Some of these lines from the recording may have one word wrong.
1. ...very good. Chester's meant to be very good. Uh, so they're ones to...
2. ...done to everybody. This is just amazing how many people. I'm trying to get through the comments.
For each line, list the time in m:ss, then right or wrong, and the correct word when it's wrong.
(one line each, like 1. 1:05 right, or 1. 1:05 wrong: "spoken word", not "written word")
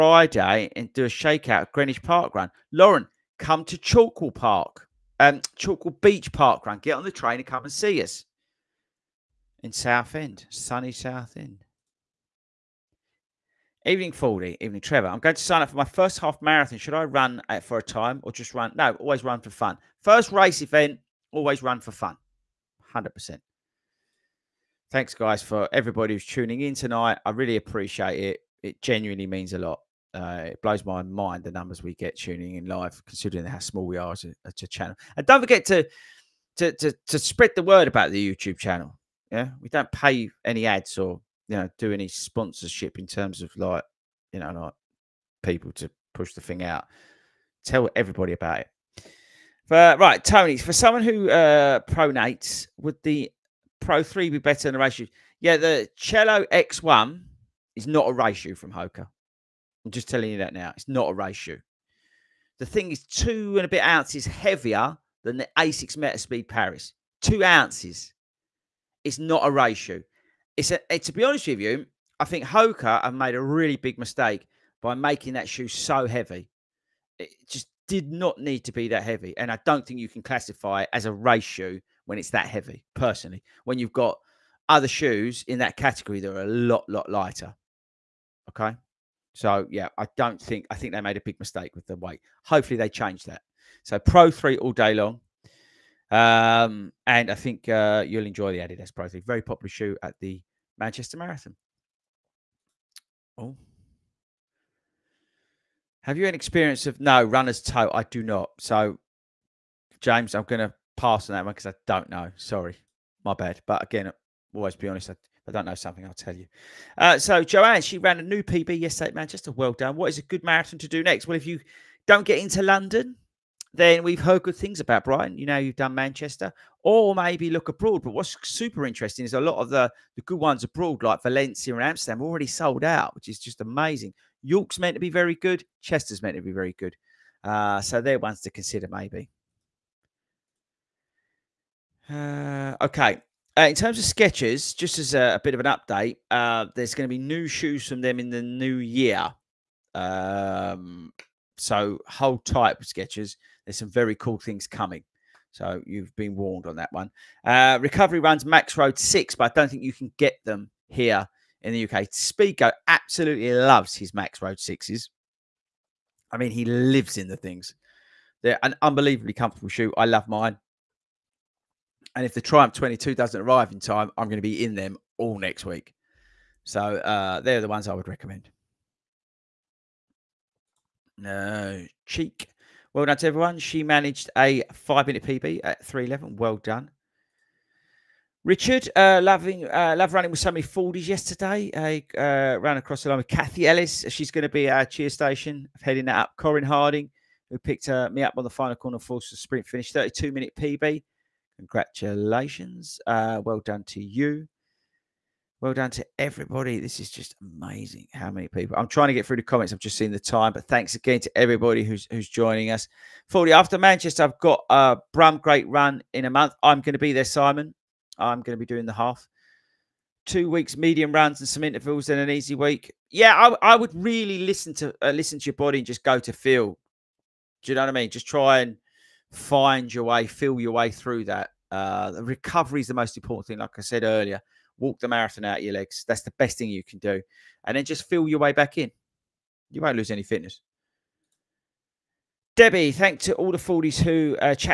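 1. 2:15 right
2. 3:25 right.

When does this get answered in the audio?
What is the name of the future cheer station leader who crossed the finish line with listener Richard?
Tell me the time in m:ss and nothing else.
3:13.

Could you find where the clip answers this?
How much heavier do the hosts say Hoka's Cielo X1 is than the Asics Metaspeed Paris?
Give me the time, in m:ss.
1:03.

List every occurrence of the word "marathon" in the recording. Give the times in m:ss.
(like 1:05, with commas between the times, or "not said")
0:16, 1:41, 2:00, 3:55.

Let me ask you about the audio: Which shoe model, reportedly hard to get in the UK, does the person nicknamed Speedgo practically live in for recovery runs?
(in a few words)
Max Road 6.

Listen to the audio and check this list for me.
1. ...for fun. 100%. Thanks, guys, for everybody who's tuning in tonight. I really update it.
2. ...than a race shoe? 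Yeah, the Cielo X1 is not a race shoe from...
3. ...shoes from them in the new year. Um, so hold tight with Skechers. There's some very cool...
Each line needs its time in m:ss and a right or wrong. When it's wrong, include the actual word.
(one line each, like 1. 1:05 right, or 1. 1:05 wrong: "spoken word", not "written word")
1. 0:21 wrong: "appreciate", not "update"
2. 0:54 right
3. 2:27 right.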